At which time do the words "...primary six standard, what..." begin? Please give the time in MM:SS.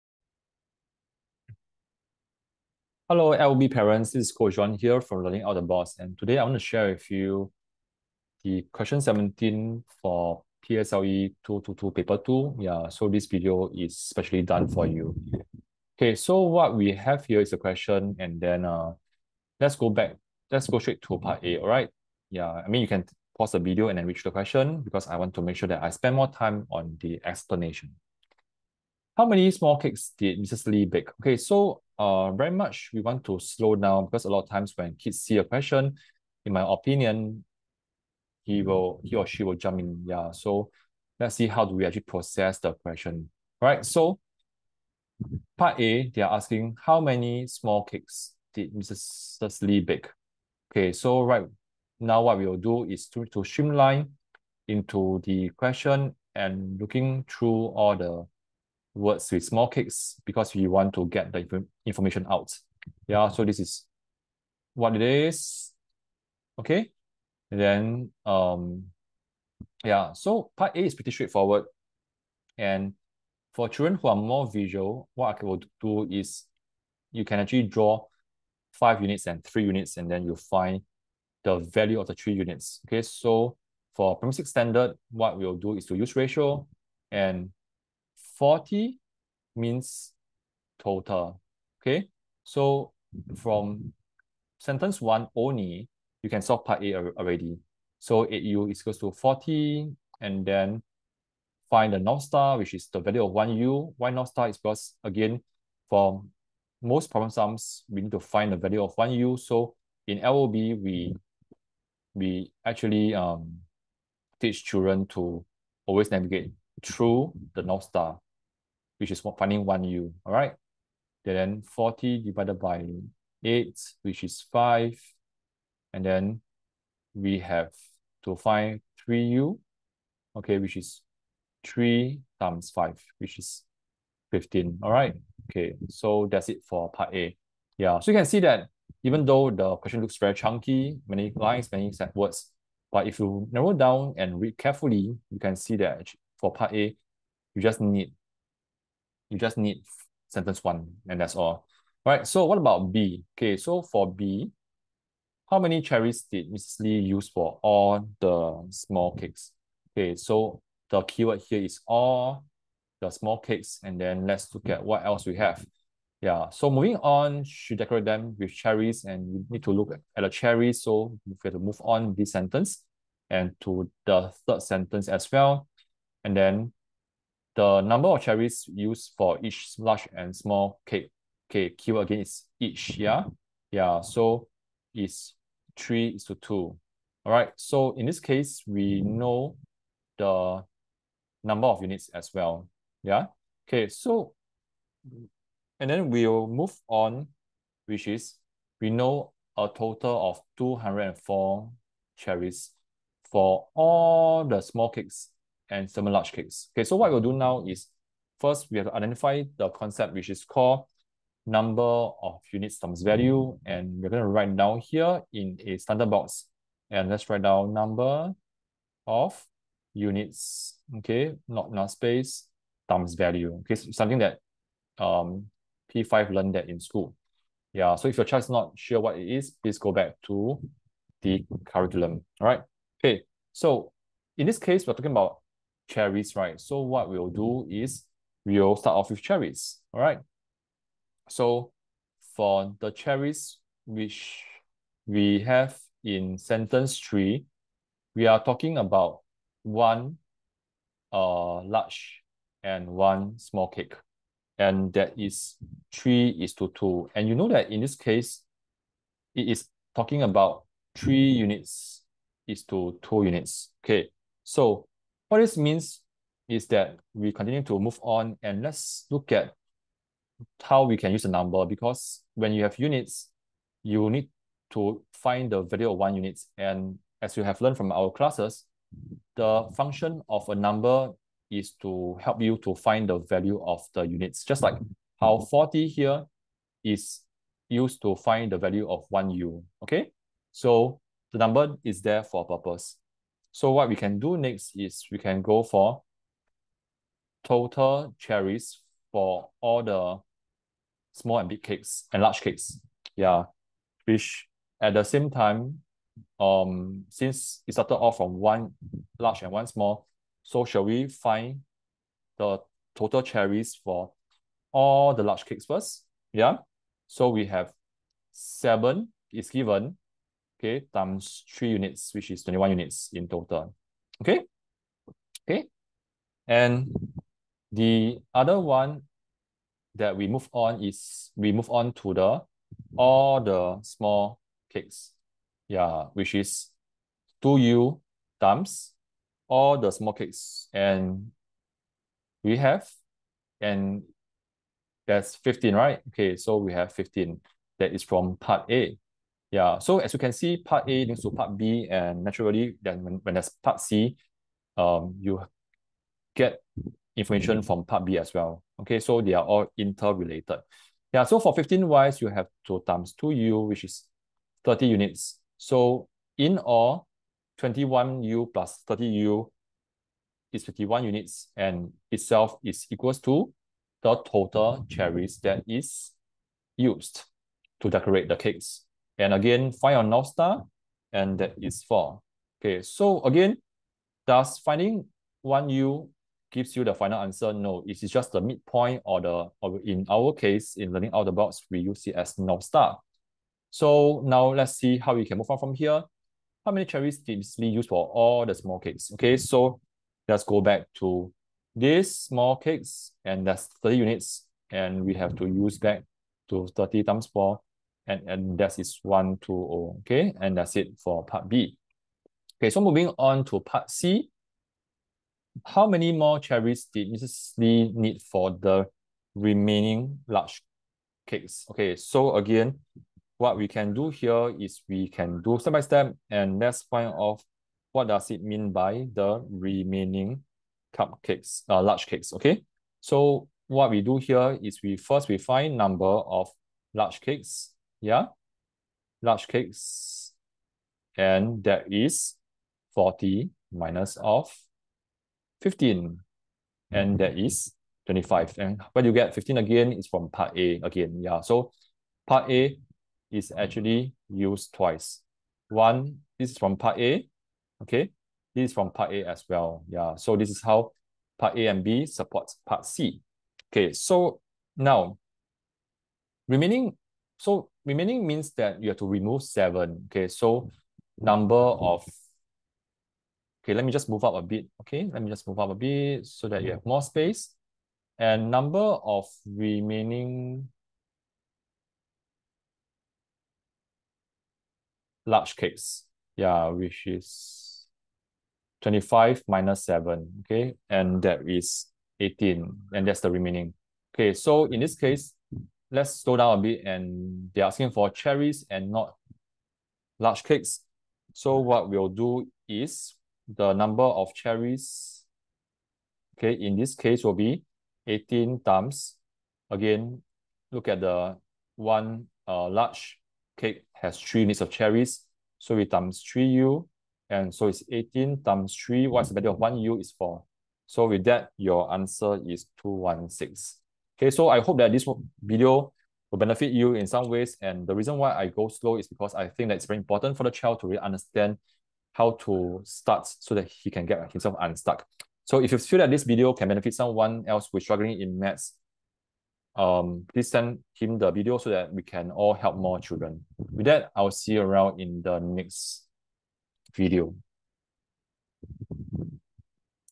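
01:24.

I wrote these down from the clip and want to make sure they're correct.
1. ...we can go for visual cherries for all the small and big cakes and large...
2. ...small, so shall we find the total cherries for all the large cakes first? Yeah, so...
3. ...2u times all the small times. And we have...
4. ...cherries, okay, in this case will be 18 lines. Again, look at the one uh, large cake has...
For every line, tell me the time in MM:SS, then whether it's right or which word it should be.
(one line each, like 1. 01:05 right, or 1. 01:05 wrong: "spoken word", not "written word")
1. 04:55 wrong: "total", not "visual"
2. 05:09 right
3. 05:37 wrong: "cakes", not "times"
4. 08:24 wrong: "times", not "lines".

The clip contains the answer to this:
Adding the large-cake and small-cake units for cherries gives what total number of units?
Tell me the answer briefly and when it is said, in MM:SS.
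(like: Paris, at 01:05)
51 units, at 06:10.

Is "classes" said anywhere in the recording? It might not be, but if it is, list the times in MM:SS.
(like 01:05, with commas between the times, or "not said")
04:38.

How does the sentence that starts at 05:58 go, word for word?
Okay, so they are all interrelated.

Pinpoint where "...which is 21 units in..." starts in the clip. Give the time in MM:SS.
05:22.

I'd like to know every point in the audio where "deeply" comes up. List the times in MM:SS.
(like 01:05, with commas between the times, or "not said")
not said.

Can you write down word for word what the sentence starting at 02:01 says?
then 40 divided by 8, which is 5.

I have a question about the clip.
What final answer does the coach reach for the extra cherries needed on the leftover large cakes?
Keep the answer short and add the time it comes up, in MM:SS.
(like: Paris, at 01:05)
216, at 08:42.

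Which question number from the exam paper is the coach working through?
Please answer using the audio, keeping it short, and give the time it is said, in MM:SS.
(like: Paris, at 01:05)
17, at 00:08.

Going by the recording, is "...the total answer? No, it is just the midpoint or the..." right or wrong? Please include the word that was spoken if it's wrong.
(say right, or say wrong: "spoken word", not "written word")
wrong: "final", not "total".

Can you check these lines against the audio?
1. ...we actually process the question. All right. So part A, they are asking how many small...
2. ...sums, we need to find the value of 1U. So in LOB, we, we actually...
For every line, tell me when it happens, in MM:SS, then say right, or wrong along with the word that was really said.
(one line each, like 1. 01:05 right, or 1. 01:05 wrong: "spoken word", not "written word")
1. 00:41 right
2. 01:47 right.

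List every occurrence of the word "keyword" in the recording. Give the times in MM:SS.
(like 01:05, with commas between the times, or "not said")
02:41, 03:01.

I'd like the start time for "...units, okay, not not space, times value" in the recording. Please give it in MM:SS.
03:39.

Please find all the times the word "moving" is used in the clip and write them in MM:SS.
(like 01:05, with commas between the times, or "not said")
02:46, 06:52.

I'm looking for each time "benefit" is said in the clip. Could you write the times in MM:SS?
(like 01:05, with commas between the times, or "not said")
08:46, 08:56.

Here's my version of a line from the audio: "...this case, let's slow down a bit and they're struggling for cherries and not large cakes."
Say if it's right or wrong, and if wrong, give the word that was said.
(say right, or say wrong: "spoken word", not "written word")
wrong: "asking", not "struggling".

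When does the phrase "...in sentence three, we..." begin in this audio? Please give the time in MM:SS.
04:06.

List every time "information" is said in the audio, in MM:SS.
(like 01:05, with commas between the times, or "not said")
01:01, 05:57.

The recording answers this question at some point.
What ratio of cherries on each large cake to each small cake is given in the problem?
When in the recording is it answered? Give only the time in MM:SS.
03:05.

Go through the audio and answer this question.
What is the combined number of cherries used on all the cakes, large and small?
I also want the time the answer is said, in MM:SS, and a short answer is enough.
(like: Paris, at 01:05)
204, at 03:20.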